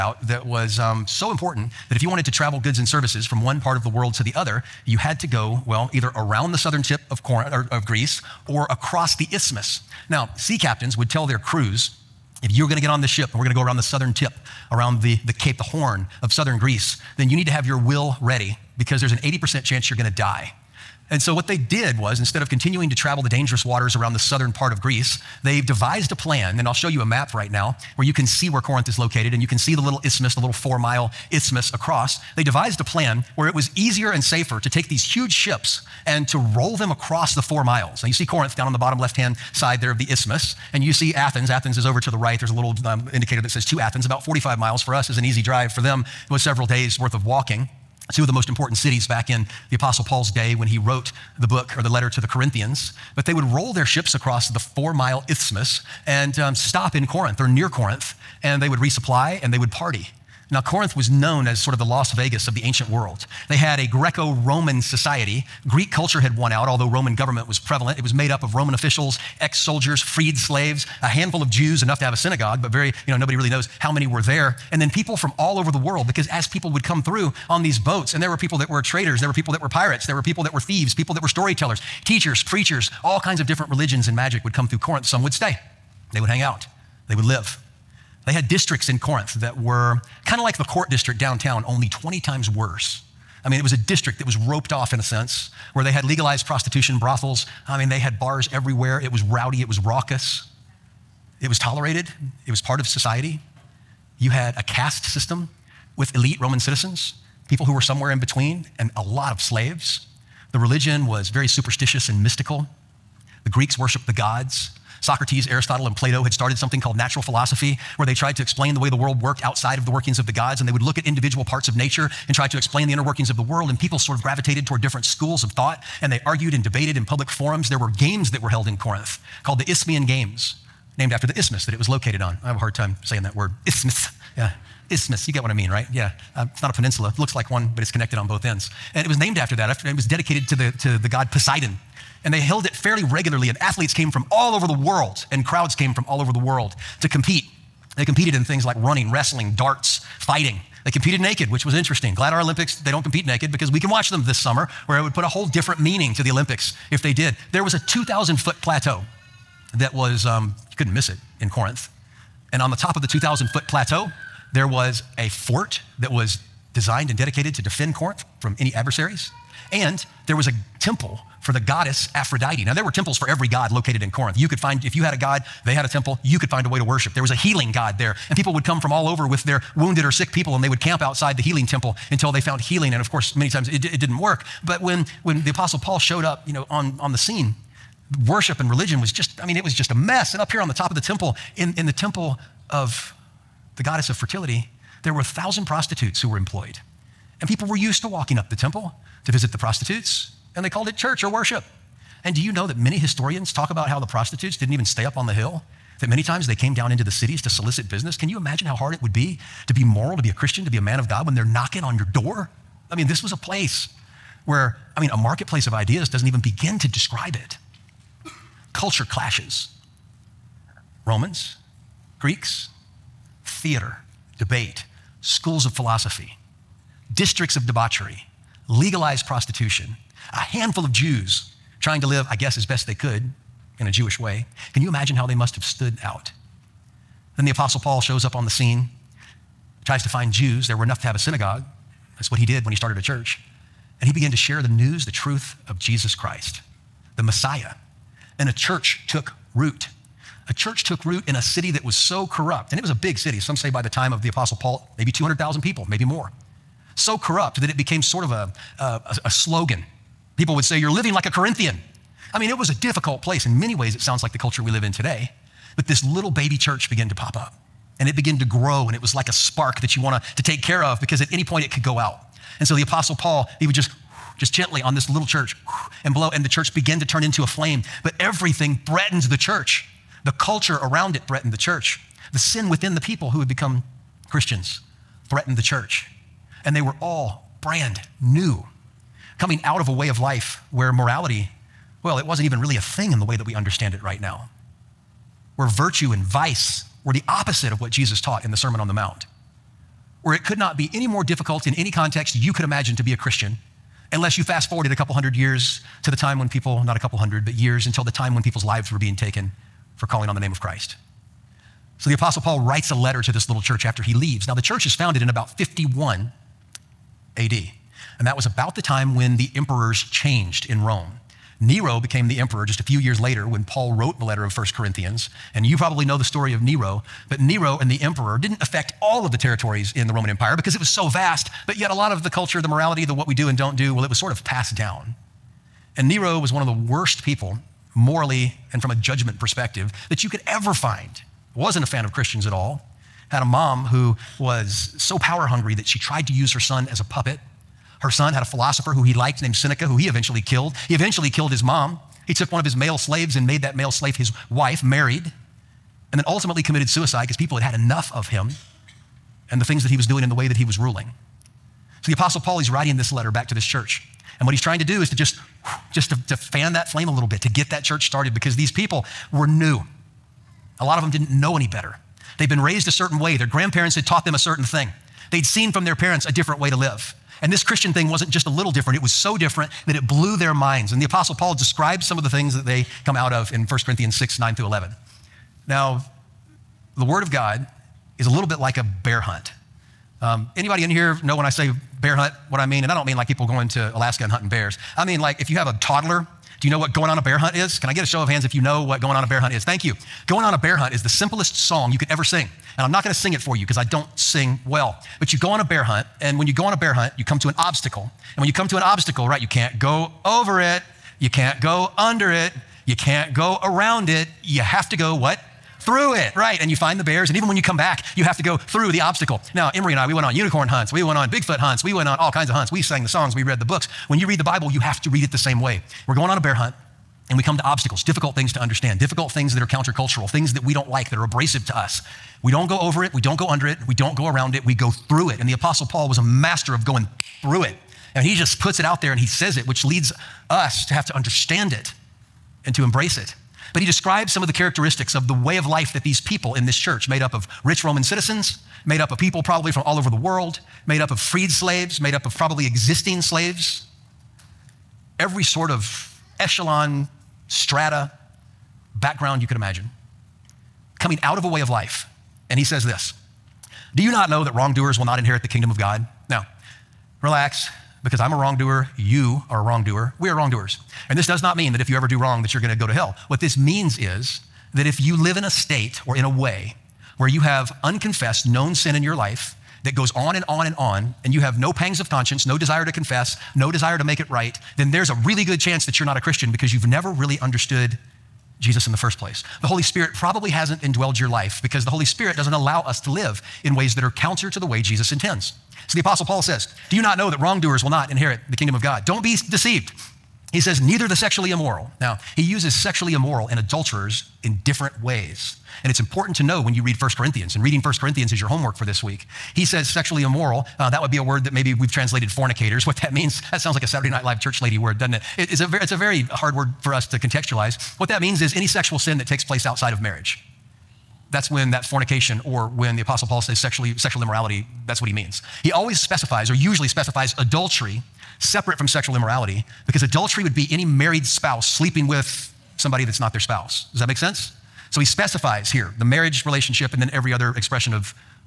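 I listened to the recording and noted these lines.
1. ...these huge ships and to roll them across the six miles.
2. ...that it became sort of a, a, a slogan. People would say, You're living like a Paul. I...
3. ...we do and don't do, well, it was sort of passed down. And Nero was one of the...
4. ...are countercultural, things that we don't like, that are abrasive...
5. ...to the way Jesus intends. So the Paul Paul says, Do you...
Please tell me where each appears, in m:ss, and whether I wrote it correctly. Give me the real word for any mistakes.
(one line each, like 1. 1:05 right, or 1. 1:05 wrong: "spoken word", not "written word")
1. 0:34 wrong: "four", not "six"
2. 4:17 wrong: "Corinthian", not "Paul"
3. 5:33 right
4. 7:09 right
5. 8:14 wrong: "Apostle", not "Paul".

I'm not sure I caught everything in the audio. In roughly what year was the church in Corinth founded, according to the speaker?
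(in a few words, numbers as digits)
51 AD.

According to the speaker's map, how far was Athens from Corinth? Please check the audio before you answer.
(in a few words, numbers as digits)
45 miles.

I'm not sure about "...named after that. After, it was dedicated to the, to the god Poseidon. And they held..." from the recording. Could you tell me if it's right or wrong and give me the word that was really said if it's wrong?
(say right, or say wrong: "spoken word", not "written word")
right.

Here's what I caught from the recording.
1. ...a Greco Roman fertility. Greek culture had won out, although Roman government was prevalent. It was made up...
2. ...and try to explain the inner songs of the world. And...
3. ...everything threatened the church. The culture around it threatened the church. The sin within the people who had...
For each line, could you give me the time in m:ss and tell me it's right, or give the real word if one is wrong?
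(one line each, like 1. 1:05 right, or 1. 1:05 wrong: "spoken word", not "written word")
1. 1:03 wrong: "society", not "fertility"
2. 2:02 wrong: "workings", not "songs"
3. 4:38 right.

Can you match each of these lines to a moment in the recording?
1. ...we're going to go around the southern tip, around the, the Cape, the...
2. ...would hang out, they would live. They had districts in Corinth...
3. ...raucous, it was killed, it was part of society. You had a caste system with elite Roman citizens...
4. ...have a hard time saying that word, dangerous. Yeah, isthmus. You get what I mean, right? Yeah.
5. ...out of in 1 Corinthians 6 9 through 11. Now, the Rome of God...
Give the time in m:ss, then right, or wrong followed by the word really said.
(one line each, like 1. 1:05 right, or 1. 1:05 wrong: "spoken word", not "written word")
1. 0:13 right
2. 1:26 right
3. 1:39 wrong: "tolerated", not "killed"
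4. 2:12 wrong: "isthmus", not "dangerous"
5. 6:23 wrong: "Word", not "Rome".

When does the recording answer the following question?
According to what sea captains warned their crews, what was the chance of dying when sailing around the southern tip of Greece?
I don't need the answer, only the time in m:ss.
0:19.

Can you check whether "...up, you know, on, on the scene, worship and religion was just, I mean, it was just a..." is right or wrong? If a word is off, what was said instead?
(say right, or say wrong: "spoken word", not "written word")
right.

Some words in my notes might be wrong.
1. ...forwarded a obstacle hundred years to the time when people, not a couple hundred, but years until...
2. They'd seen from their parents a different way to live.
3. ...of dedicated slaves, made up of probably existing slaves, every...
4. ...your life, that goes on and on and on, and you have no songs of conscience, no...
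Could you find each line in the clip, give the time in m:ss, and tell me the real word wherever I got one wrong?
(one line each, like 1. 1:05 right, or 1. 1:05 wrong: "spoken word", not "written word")
1. 5:04 wrong: "couple", not "obstacle"
2. 6:15 right
3. 7:31 wrong: "freed", not "dedicated"
4. 7:59 wrong: "pangs", not "songs".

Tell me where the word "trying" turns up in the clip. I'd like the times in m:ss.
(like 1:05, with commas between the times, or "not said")
3:51, 6:04.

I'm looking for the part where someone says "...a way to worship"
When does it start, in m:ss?
2:56.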